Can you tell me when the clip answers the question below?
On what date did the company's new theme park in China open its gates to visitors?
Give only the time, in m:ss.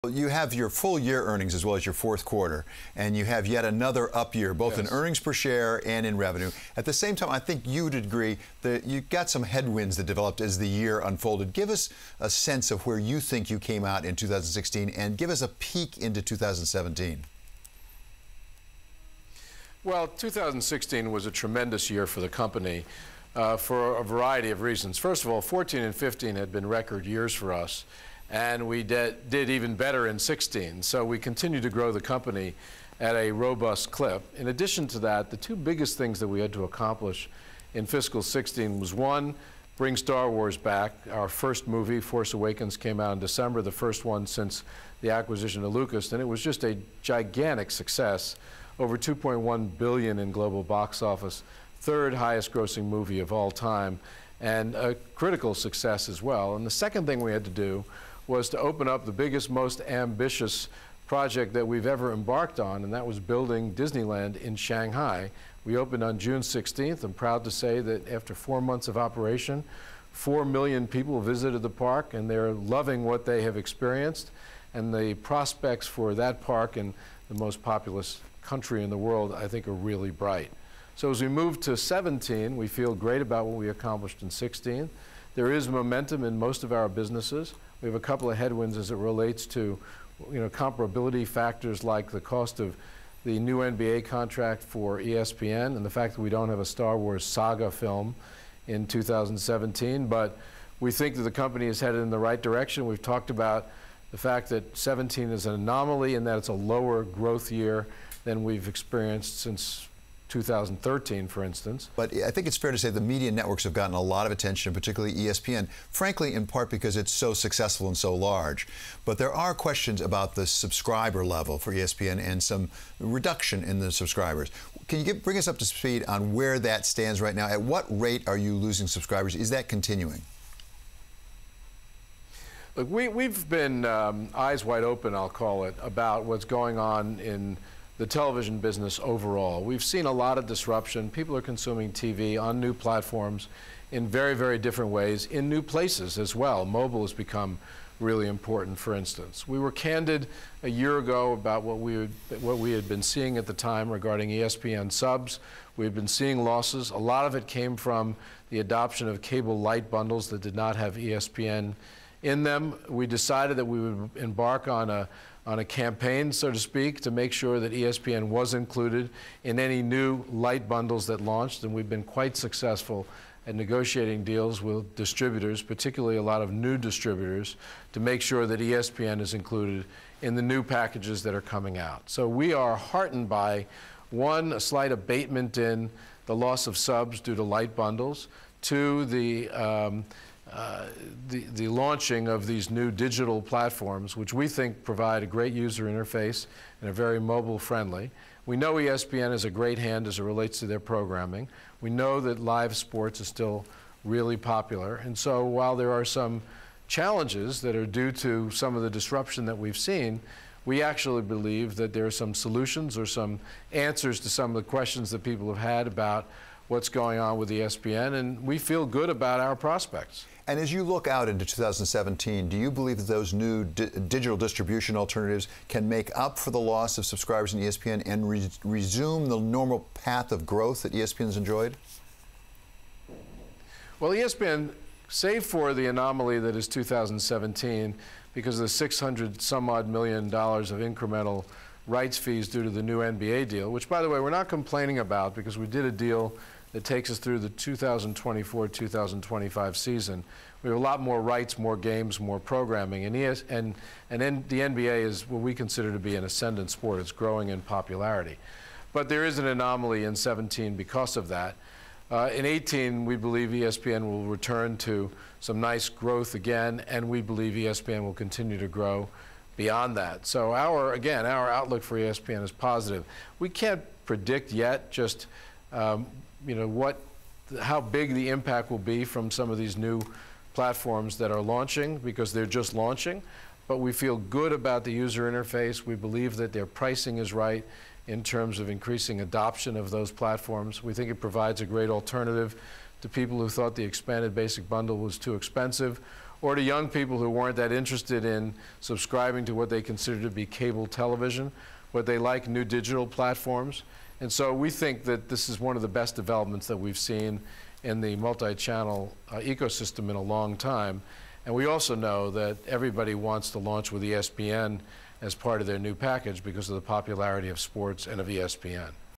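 1:06.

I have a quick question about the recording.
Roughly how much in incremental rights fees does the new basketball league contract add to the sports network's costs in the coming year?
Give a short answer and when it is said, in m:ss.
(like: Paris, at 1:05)
$600 million, at 3:58.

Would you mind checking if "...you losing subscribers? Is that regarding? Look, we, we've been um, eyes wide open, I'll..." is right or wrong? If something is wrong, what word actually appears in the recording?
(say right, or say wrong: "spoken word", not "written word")
wrong: "continuing", not "regarding".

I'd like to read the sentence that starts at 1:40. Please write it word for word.
But we think that the company is headed in the right direction.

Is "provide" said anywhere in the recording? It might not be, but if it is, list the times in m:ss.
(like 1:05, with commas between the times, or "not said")
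3:14, 4:51.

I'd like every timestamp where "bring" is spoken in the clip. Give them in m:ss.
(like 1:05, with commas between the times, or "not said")
0:39, 2:05.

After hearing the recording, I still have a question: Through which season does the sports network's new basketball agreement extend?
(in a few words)
2024-2025 season.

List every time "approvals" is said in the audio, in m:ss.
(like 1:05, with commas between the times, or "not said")
not said.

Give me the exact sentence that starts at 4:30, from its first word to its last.
So our, again, our outlook for ESPN is positive.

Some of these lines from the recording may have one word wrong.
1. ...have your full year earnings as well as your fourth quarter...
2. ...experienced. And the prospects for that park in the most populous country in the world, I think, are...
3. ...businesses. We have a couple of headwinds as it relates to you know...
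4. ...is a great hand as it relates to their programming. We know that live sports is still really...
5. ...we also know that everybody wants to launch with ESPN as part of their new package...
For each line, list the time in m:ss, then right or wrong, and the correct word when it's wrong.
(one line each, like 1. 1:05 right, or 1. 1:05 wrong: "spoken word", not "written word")
1. 0:00 right
2. 1:13 right
3. 1:26 right
4. 3:19 right
5. 5:11 right.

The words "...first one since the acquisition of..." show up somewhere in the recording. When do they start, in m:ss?
0:43.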